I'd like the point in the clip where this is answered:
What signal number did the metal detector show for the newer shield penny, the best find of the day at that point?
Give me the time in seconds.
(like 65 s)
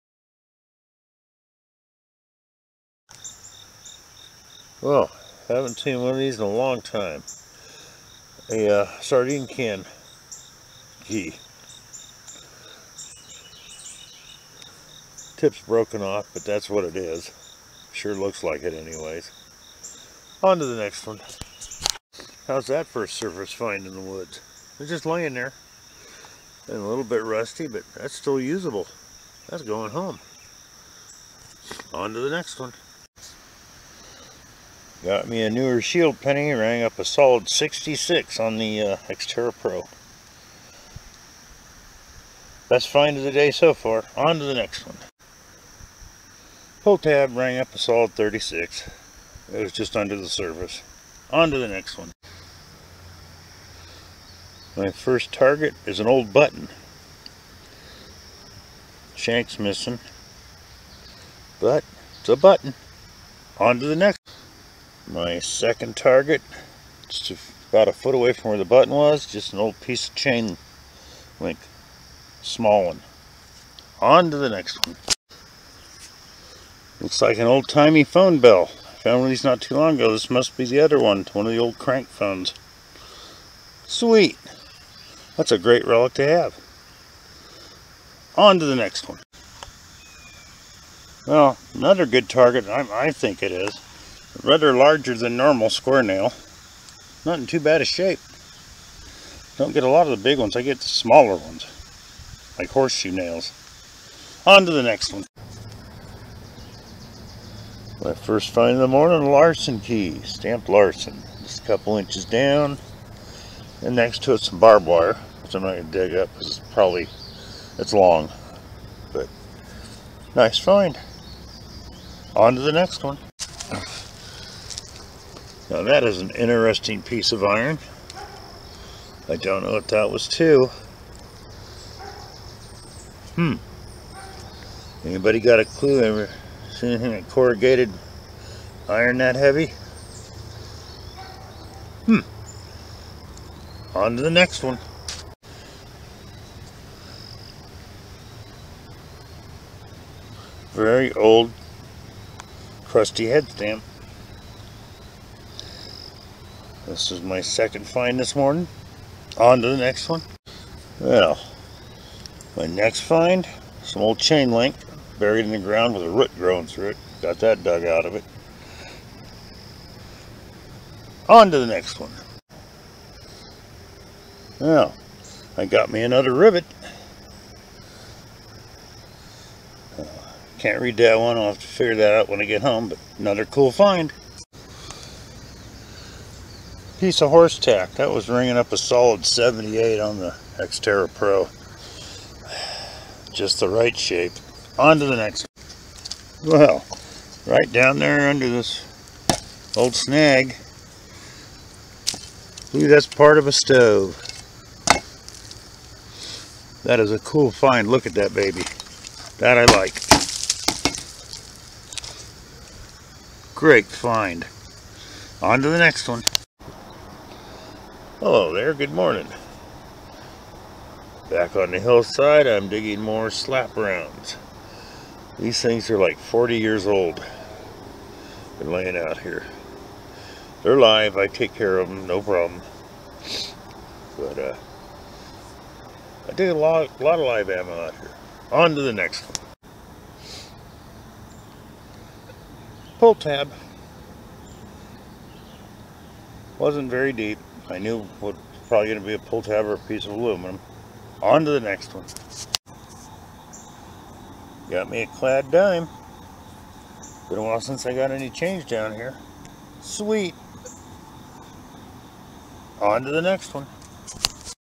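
37 s.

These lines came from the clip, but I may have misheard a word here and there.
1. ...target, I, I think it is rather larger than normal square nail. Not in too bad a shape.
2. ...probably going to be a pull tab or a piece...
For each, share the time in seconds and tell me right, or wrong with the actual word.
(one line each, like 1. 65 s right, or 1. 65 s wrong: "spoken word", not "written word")
1. 92 s right
2. 248 s right.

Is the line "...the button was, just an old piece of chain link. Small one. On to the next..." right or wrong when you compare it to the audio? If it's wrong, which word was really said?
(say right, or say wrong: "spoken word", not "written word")
right.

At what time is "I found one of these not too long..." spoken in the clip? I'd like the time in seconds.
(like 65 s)
78 s.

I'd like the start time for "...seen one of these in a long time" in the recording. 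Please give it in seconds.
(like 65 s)
5 s.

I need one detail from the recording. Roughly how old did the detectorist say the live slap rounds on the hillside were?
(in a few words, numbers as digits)
40 years.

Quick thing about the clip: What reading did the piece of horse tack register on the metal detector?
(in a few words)
78.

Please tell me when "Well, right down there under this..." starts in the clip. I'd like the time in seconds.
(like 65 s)
196 s.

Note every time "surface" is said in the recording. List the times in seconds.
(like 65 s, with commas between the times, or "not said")
23 s, 50 s.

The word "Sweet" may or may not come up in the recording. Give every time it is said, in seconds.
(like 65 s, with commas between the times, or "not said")
83 s, 259 s.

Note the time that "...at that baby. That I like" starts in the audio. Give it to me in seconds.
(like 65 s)
208 s.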